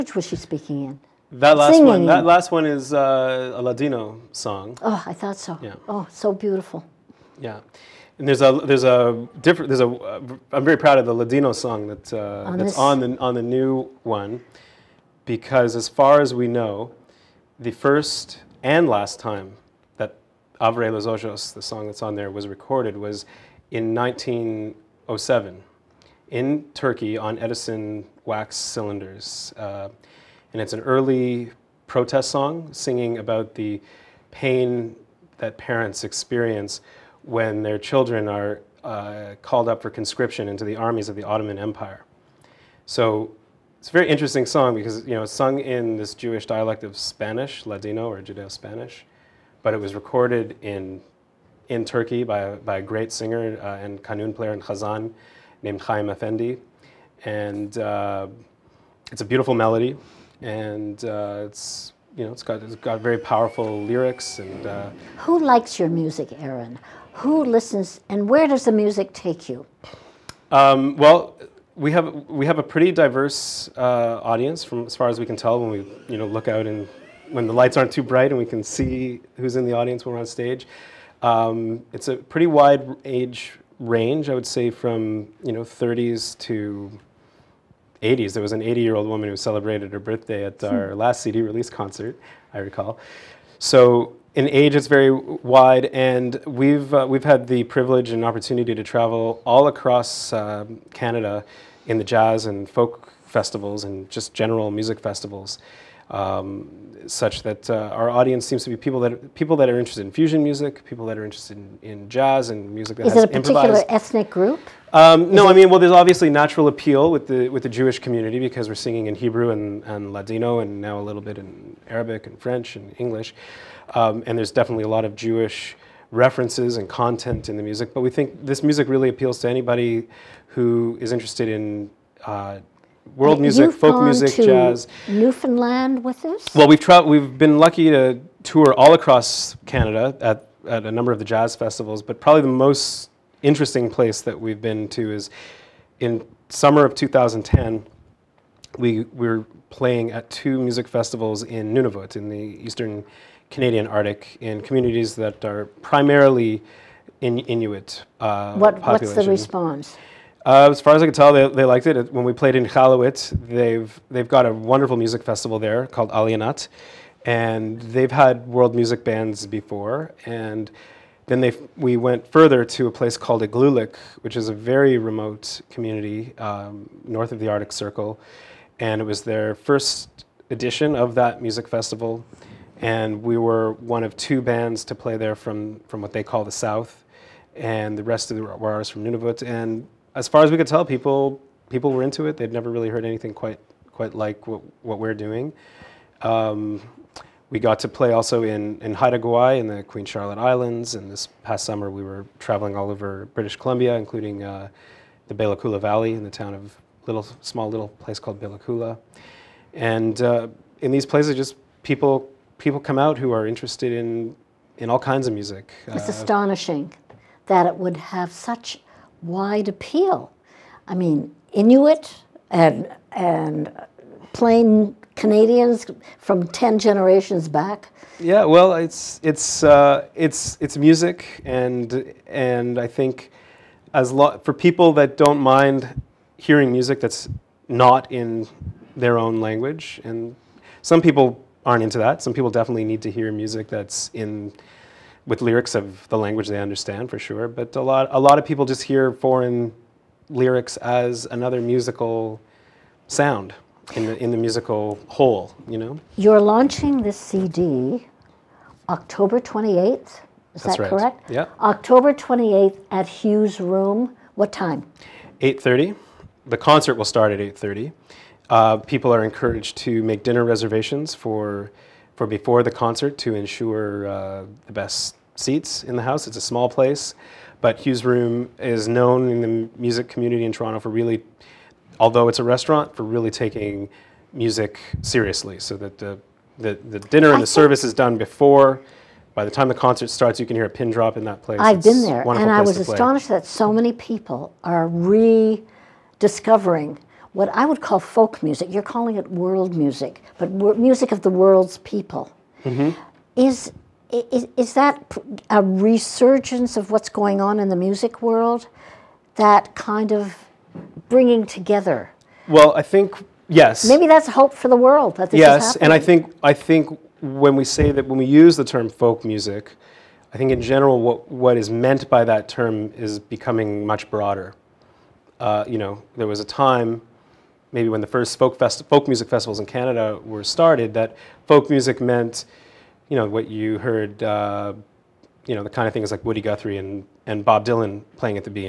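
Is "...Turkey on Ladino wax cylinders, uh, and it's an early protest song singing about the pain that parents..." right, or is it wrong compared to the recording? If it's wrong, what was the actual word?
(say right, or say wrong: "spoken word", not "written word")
wrong: "Edison", not "Ladino".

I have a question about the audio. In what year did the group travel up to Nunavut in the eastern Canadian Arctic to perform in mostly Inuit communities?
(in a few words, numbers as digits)
2010.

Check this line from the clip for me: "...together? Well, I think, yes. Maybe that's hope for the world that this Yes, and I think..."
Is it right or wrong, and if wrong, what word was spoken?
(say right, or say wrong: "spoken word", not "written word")
right.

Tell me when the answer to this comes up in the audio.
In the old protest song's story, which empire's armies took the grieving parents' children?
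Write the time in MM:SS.
00:41.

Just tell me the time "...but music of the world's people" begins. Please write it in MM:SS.
05:00.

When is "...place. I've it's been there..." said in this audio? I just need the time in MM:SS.
04:51.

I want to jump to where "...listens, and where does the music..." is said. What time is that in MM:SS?
01:07.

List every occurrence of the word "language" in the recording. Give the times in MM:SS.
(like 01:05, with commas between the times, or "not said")
03:59, 04:06.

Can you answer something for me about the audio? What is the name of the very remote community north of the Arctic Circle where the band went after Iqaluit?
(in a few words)
Igloolik.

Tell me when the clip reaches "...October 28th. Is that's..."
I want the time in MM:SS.
04:18.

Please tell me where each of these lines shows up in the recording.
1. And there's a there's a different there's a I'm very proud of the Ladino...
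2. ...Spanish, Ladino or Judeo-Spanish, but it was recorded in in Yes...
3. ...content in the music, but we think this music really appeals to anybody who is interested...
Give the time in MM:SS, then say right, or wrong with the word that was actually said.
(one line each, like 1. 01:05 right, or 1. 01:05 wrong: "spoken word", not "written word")
1. 00:08 right
2. 00:46 wrong: "Turkey", not "Yes"
3. 02:06 right.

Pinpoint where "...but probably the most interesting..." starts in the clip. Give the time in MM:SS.
02:22.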